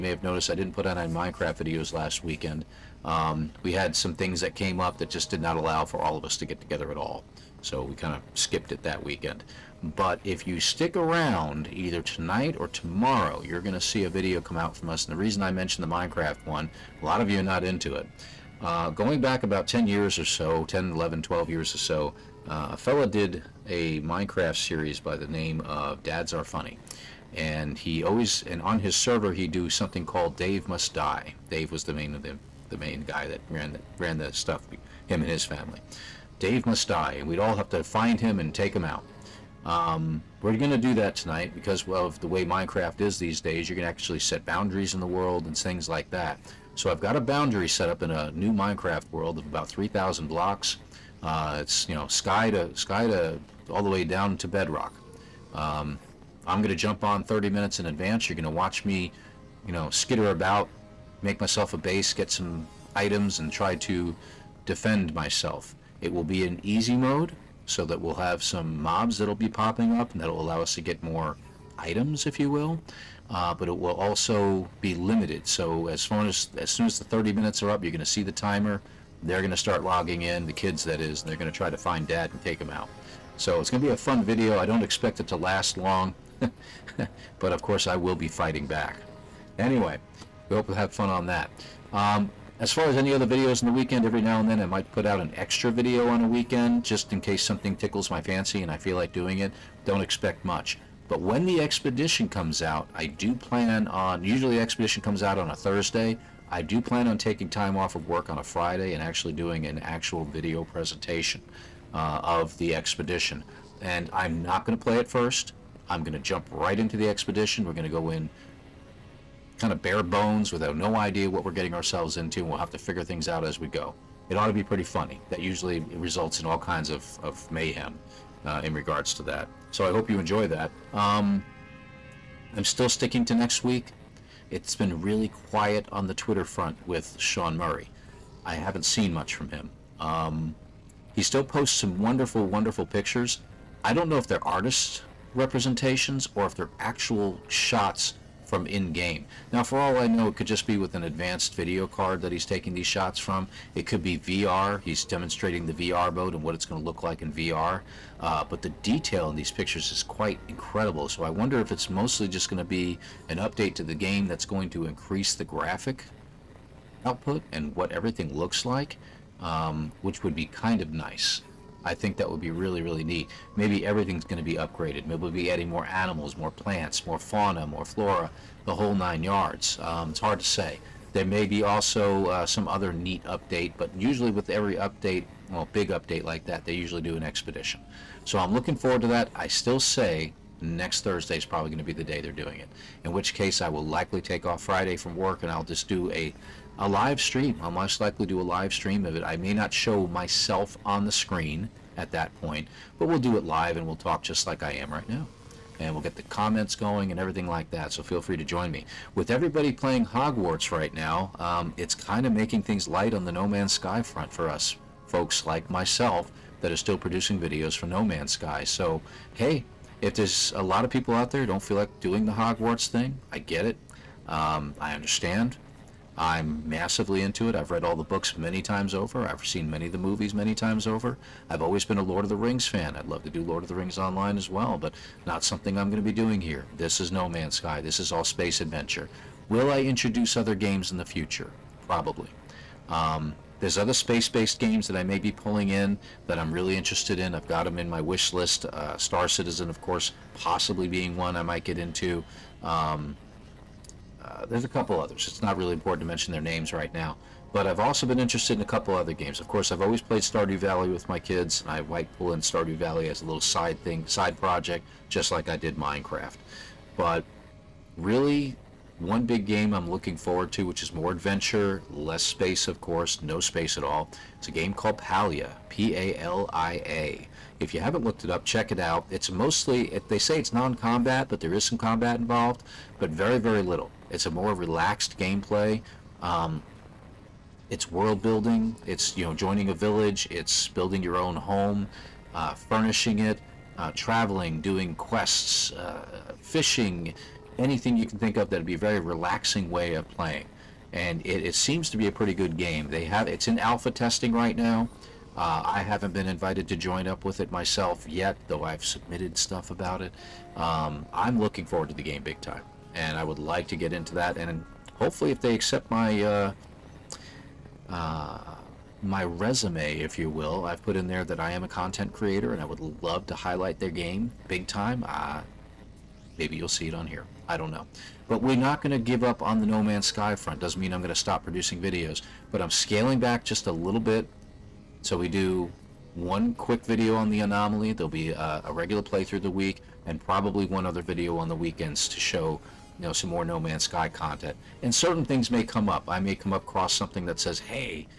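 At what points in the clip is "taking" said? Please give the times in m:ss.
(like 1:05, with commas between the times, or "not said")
1:47, 2:32.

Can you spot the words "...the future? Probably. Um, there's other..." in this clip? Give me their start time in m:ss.
4:00.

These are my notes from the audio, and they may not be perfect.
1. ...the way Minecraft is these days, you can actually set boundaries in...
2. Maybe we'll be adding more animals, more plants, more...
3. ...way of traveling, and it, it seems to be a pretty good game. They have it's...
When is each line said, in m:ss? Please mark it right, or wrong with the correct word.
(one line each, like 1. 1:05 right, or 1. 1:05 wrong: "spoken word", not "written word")
1. 0:42 right
2. 2:55 right
3. 4:59 wrong: "playing", not "traveling".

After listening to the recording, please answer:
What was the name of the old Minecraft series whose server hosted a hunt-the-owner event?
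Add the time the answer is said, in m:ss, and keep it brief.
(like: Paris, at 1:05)
Dads Are Funny, at 0:26.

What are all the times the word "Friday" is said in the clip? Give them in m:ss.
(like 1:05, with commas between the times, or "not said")
1:48, 3:14.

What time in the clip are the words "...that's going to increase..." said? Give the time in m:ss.
2:44.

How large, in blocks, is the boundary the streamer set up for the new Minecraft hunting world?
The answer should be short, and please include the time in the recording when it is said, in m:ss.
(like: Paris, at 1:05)
3,000 blocks, at 0:49.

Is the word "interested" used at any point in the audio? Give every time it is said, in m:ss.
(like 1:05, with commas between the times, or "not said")
4:06, 4:18.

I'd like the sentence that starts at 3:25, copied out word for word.
And we'll get the comments going and everything like that, so feel free to join me.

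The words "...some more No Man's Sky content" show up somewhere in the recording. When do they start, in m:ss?
5:43.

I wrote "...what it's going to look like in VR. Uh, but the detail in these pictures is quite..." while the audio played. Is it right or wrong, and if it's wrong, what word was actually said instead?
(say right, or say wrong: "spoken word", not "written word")
right.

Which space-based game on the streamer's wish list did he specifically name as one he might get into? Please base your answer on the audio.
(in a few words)
Star Citizen.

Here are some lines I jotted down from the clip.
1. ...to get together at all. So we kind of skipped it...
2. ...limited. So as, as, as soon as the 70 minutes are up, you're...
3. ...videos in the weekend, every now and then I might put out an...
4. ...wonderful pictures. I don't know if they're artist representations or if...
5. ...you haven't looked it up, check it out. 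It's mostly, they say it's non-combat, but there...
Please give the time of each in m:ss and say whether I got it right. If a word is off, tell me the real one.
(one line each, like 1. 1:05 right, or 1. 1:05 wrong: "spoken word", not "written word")
1. 0:06 right
2. 1:14 wrong: "30", not "70"
3. 1:33 right
4. 2:22 right
5. 4:37 right.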